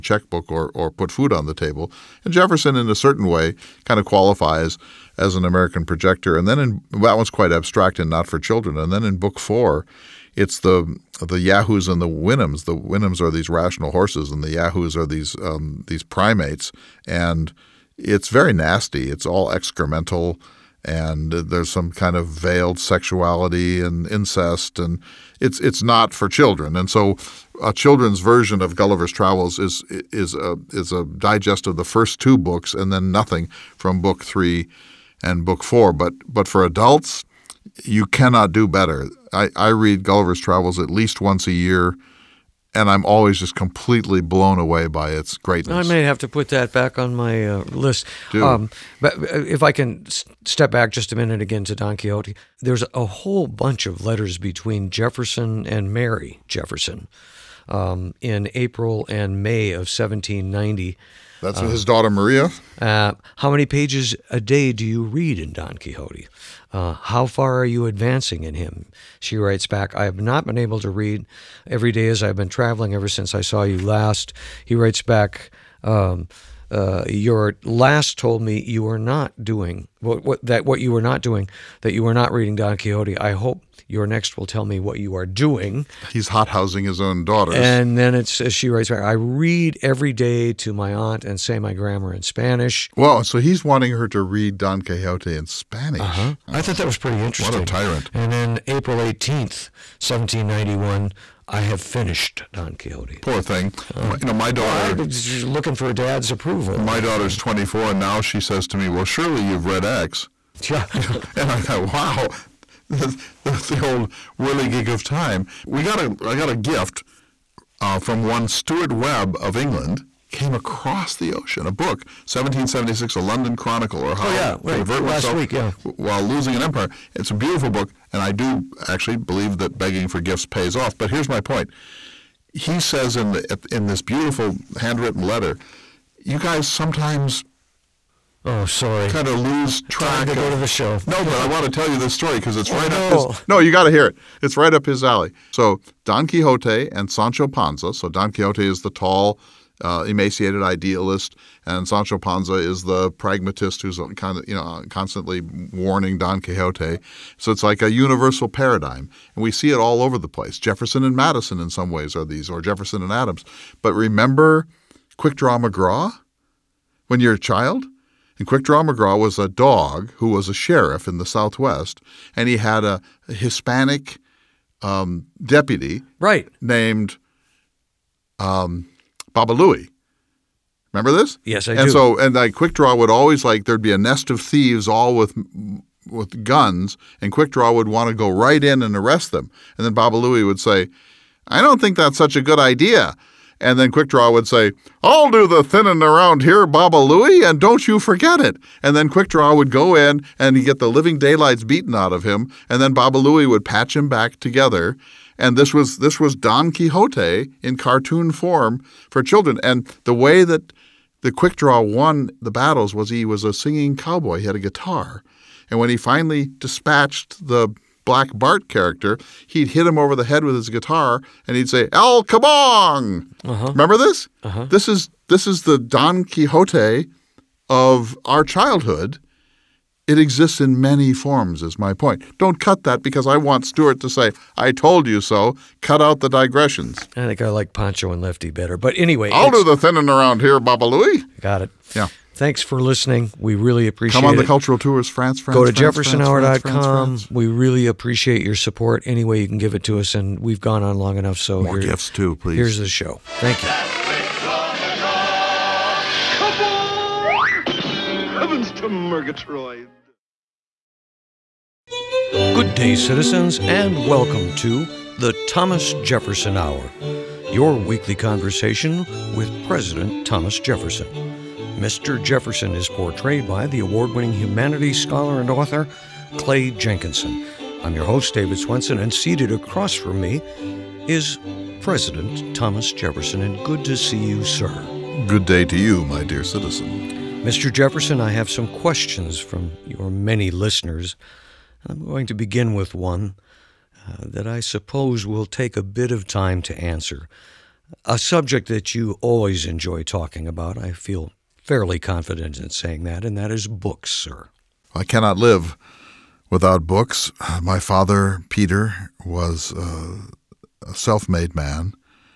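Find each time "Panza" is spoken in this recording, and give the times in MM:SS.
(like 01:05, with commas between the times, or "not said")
02:27, 02:32.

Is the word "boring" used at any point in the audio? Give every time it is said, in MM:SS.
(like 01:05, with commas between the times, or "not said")
not said.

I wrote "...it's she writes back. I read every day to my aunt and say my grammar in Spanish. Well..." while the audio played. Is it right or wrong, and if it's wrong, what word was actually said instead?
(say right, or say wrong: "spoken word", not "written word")
right.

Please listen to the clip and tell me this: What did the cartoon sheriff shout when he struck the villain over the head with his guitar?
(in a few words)
El Kabong.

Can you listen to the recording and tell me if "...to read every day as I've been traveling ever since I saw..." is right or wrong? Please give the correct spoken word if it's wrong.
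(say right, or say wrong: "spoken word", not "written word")
right.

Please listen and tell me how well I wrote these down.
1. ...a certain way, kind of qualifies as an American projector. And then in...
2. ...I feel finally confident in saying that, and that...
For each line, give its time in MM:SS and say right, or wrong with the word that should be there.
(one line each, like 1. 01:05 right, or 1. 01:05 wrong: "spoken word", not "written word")
1. 00:02 right
2. 05:00 wrong: "fairly", not "finally".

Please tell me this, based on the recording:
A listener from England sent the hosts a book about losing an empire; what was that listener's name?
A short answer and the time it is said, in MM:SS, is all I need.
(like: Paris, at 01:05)
Stuart Webb, at 01:58.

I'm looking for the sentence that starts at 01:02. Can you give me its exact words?
Uh, how many pages a day do you read in Don Quixote?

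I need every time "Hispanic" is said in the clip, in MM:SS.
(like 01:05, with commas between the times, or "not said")
02:53.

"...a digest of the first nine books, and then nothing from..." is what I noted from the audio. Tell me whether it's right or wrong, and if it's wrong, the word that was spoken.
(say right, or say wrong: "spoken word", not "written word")
wrong: "two", not "nine".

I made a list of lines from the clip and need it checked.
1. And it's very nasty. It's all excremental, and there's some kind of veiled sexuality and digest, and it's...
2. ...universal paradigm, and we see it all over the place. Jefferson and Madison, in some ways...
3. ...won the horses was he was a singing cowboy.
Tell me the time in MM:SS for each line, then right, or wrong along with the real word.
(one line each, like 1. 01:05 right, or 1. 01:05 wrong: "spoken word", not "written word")
1. 00:17 wrong: "incest", not "digest"
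2. 02:37 right
3. 03:31 wrong: "battles", not "horses".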